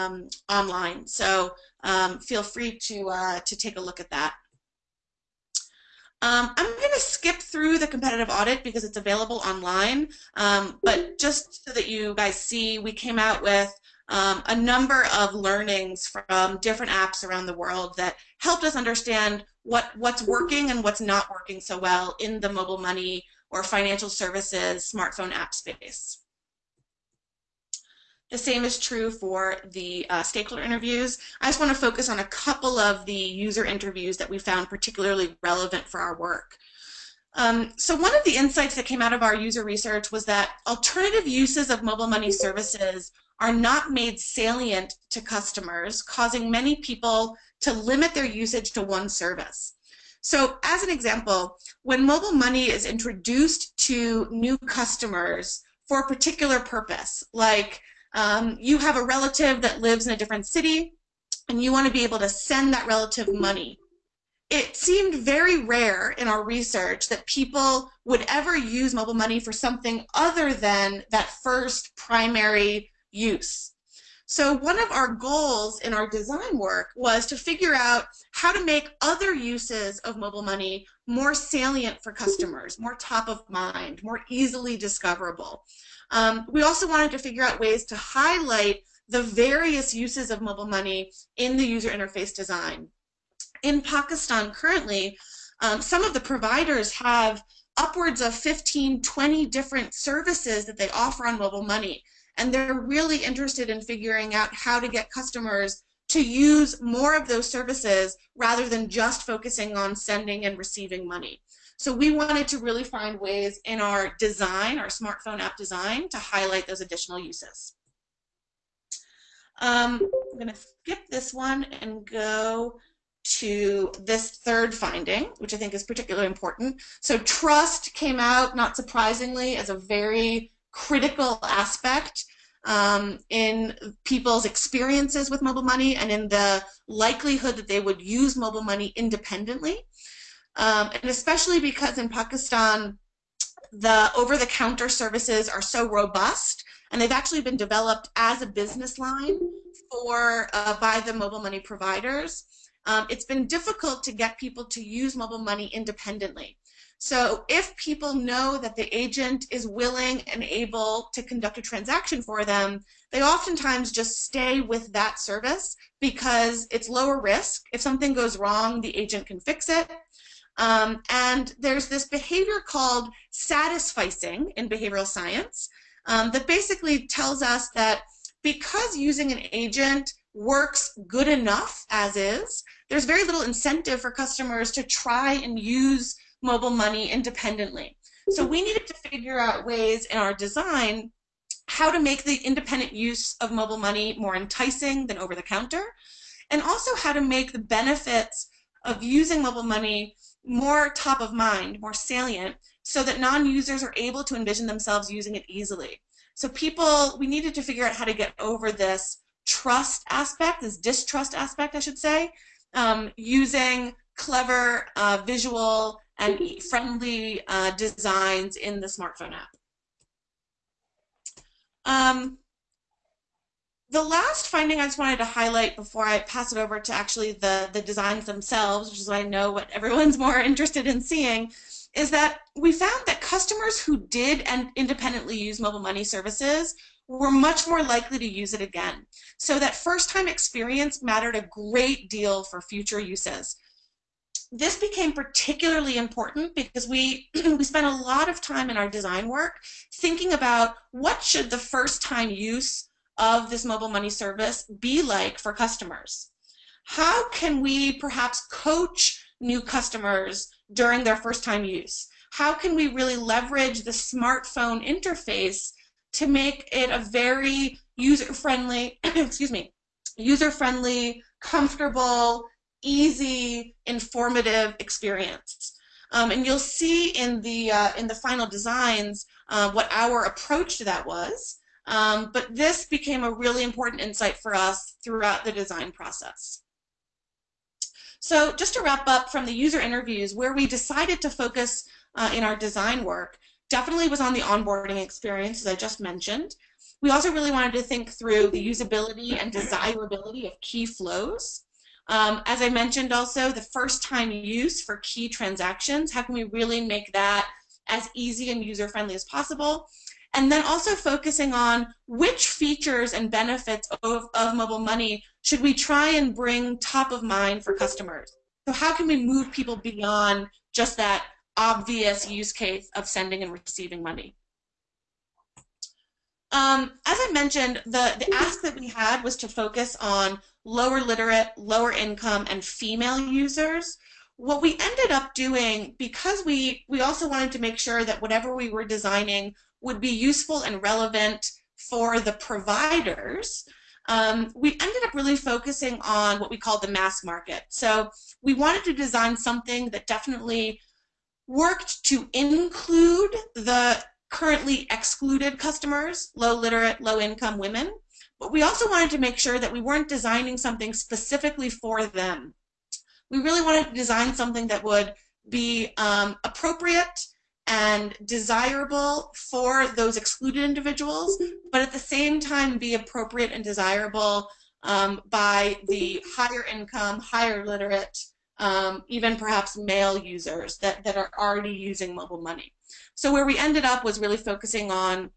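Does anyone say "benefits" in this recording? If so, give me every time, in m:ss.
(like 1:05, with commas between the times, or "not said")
3:17, 5:13.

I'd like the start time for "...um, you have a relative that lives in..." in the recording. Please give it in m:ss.
0:58.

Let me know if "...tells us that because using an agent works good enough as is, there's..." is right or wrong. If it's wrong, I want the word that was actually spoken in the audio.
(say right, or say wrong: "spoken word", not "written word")
right.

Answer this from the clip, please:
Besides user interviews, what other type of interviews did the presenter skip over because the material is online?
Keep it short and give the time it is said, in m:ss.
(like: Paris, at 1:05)
stakeholder interviews, at 0:30.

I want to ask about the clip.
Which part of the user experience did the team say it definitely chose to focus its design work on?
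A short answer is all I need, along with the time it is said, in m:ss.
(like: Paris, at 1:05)
the onboarding experience, at 4:54.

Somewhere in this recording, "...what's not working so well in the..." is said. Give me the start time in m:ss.
0:20.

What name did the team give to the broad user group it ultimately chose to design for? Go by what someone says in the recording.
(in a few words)
the mass market.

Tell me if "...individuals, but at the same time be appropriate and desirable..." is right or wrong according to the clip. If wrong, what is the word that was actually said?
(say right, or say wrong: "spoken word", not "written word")
right.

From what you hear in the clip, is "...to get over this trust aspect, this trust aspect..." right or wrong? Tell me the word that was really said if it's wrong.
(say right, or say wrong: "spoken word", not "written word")
wrong: "distrust", not "trust".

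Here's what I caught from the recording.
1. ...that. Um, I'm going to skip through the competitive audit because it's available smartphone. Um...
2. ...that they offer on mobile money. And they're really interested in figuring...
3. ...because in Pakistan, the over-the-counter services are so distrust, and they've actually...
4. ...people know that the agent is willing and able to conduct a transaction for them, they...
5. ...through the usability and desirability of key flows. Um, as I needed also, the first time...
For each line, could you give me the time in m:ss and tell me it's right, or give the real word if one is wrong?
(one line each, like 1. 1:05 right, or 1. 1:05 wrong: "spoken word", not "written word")
1. 0:04 wrong: "online", not "smartphone"
2. 1:40 right
3. 2:21 wrong: "robust", not "distrust"
4. 2:37 right
5. 4:58 wrong: "mentioned", not "needed".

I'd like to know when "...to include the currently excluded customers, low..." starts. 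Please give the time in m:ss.
5:52.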